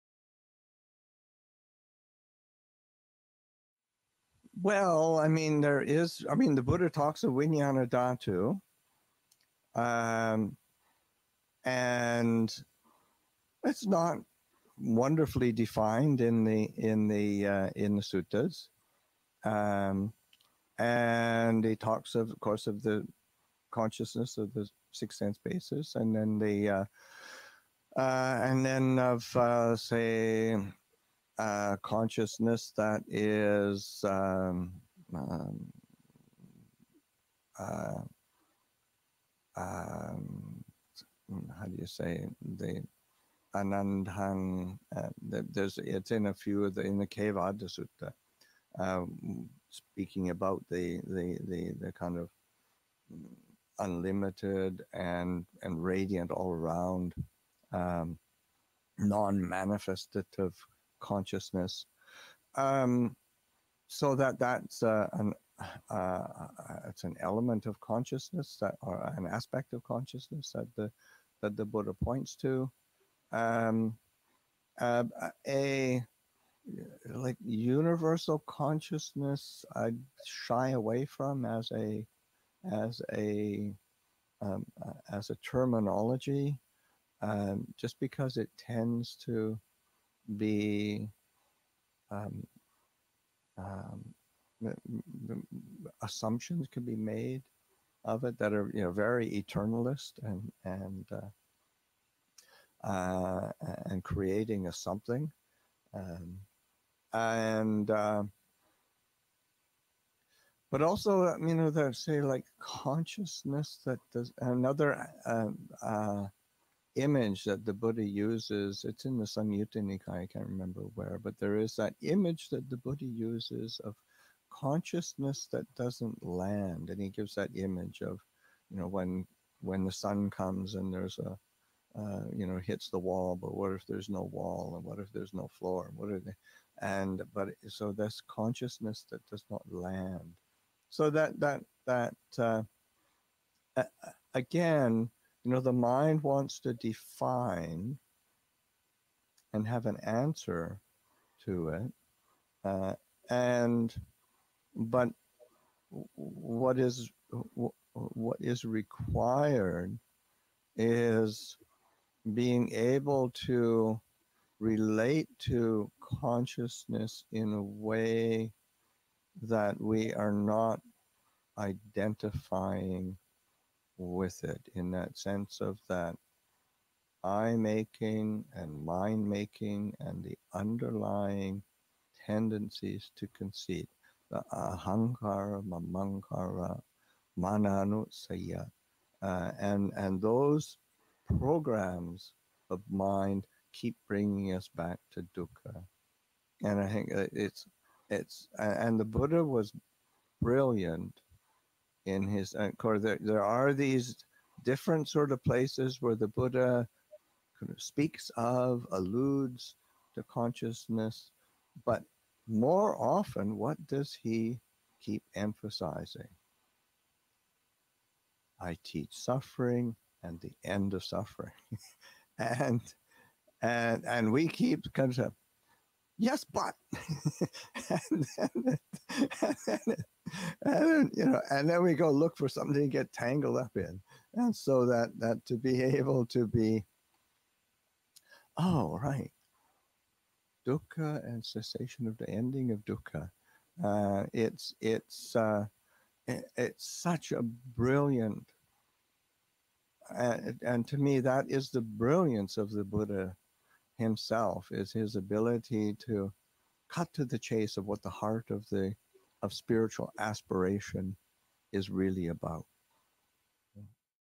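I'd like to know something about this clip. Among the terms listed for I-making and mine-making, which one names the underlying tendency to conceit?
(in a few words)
mananusaya.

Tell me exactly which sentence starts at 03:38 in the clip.
I teach suffering and the end of suffering.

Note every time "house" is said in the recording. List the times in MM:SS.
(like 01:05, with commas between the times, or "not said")
not said.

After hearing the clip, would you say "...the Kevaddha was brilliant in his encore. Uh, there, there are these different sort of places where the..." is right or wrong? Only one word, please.
wrong.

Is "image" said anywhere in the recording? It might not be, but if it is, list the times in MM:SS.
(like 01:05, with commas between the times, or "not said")
01:56, 02:02, 02:07.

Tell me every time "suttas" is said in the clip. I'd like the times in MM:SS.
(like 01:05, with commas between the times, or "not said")
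00:18, 00:47.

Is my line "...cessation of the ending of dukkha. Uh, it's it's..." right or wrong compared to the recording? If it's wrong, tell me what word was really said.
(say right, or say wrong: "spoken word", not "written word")
right.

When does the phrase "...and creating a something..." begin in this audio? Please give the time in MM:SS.
01:43.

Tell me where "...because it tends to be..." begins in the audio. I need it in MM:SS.
01:27.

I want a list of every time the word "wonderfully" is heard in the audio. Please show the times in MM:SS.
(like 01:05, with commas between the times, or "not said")
00:14.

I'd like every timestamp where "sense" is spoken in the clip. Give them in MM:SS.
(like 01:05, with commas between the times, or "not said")
00:25, 02:55.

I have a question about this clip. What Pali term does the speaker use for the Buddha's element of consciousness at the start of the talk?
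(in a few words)
Vijnana Dhatu.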